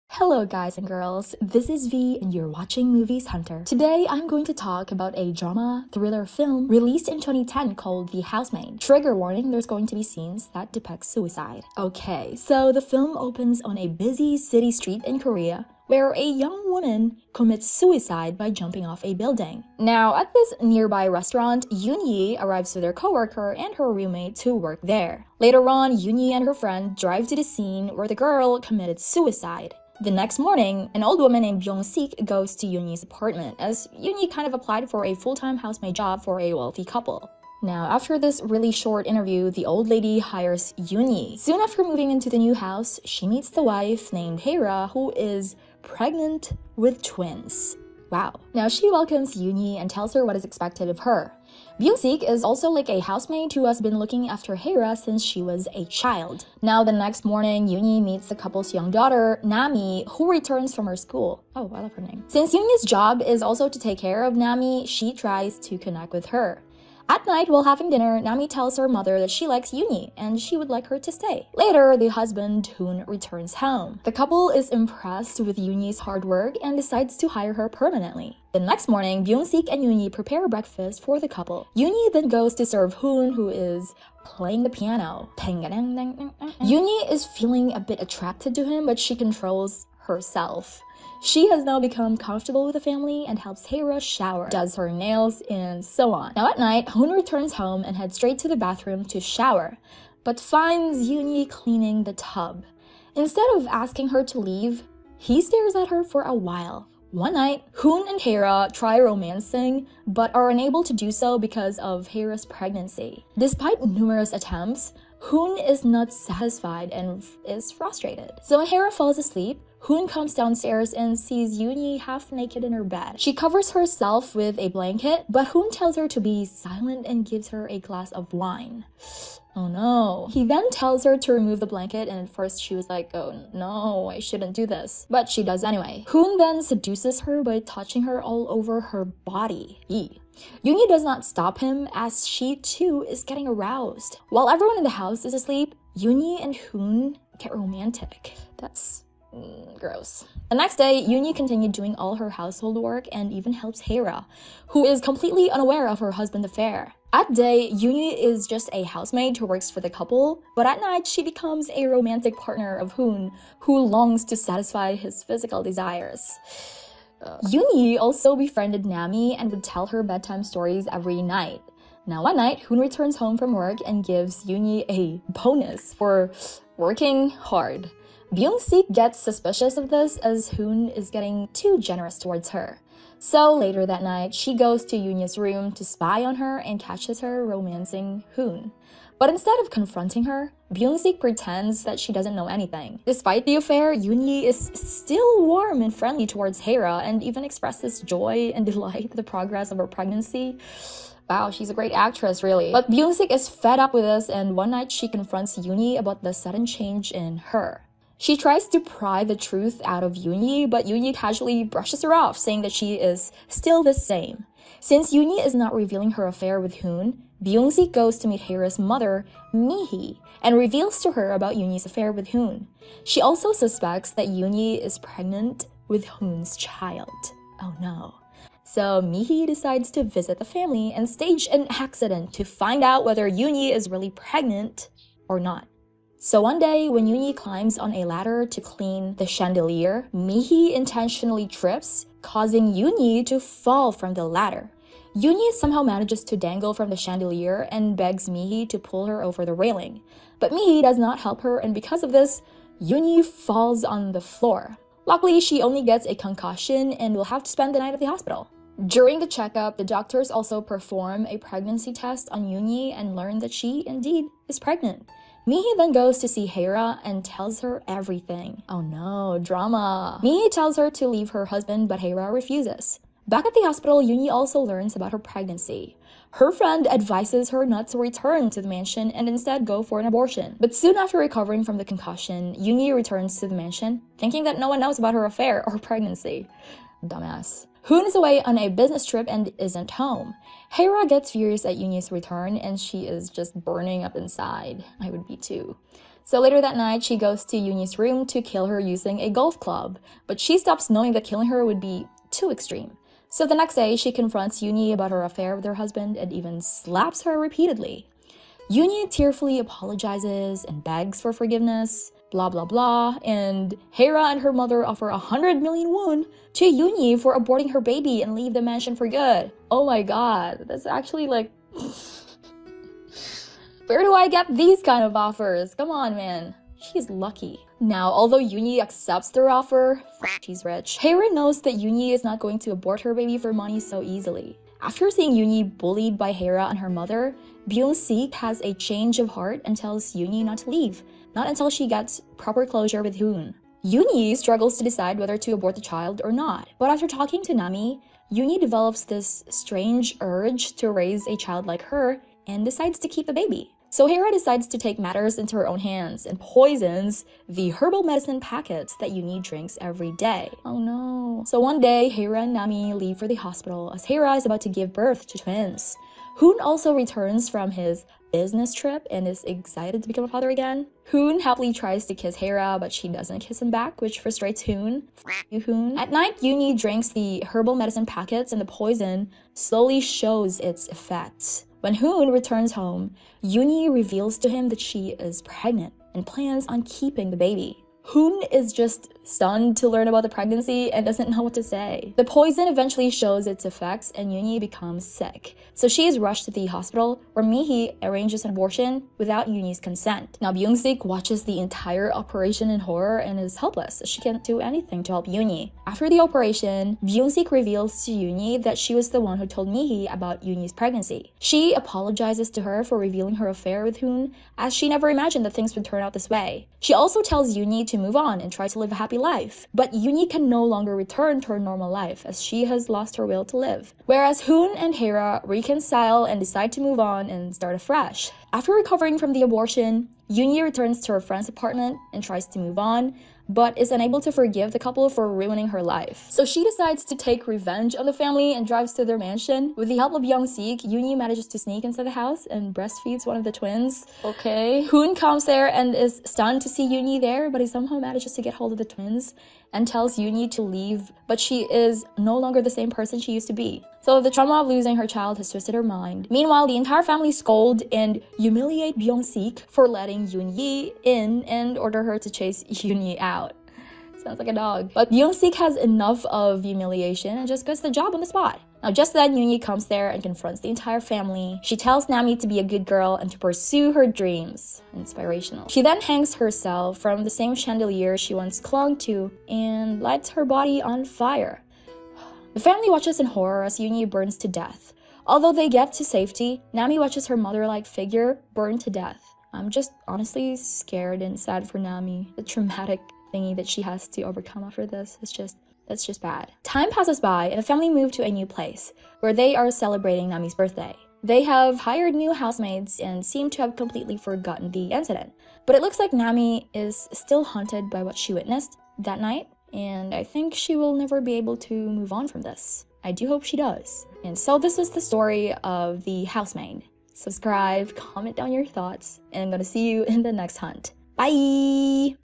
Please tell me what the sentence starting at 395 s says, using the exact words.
So she is rushed to the hospital where Mihi arranges an abortion without Yuni's consent.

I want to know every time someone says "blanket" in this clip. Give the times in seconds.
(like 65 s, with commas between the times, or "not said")
124 s, 131 s.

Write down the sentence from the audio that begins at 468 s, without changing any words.
Now, just then, Yuni comes there and confronts the entire family.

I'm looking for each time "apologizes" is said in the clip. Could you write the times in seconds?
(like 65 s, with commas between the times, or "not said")
309 s, 411 s.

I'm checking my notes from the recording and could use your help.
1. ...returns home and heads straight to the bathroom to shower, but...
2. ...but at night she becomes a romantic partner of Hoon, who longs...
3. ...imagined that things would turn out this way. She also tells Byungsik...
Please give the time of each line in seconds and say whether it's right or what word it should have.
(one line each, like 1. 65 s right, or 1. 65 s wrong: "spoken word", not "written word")
1. 97 s right
2. 160 s right
3. 415 s wrong: "Yuni", not "Byungsik".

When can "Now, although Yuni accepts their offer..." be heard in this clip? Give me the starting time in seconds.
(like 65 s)
327 s.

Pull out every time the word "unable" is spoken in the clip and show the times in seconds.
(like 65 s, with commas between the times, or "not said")
110 s, 433 s.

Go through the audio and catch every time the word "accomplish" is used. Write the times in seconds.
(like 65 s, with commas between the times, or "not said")
not said.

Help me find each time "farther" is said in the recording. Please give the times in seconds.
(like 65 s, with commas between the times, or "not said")
not said.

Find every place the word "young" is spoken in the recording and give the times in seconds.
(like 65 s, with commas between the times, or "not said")
16 s, 58 s.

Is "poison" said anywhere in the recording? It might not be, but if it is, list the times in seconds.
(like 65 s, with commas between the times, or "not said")
356 s, 378 s, 392 s.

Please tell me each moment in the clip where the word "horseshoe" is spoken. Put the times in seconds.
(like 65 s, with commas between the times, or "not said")
not said.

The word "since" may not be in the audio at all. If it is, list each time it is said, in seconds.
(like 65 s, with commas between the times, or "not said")
54 s, 62 s, 214 s.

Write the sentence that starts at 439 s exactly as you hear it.
With the help of Byung-sik, Yuni manages to sneak inside the house and breastfeeds one of the twins.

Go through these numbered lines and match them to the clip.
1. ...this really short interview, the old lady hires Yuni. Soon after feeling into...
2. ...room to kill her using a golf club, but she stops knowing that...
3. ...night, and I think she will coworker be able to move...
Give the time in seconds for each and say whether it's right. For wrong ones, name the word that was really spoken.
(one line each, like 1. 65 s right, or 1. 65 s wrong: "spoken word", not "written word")
1. 38 s wrong: "moving", not "feeling"
2. 297 s right
3. 509 s wrong: "never", not "coworker".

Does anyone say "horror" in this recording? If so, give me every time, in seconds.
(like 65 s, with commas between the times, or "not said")
402 s, 483 s.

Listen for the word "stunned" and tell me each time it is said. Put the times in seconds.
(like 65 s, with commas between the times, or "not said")
389 s, 446 s.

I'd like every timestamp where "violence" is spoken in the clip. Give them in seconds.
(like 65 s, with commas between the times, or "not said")
not said.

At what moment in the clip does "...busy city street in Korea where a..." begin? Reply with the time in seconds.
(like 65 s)
13 s.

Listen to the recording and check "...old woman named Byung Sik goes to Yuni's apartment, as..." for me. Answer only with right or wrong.
right.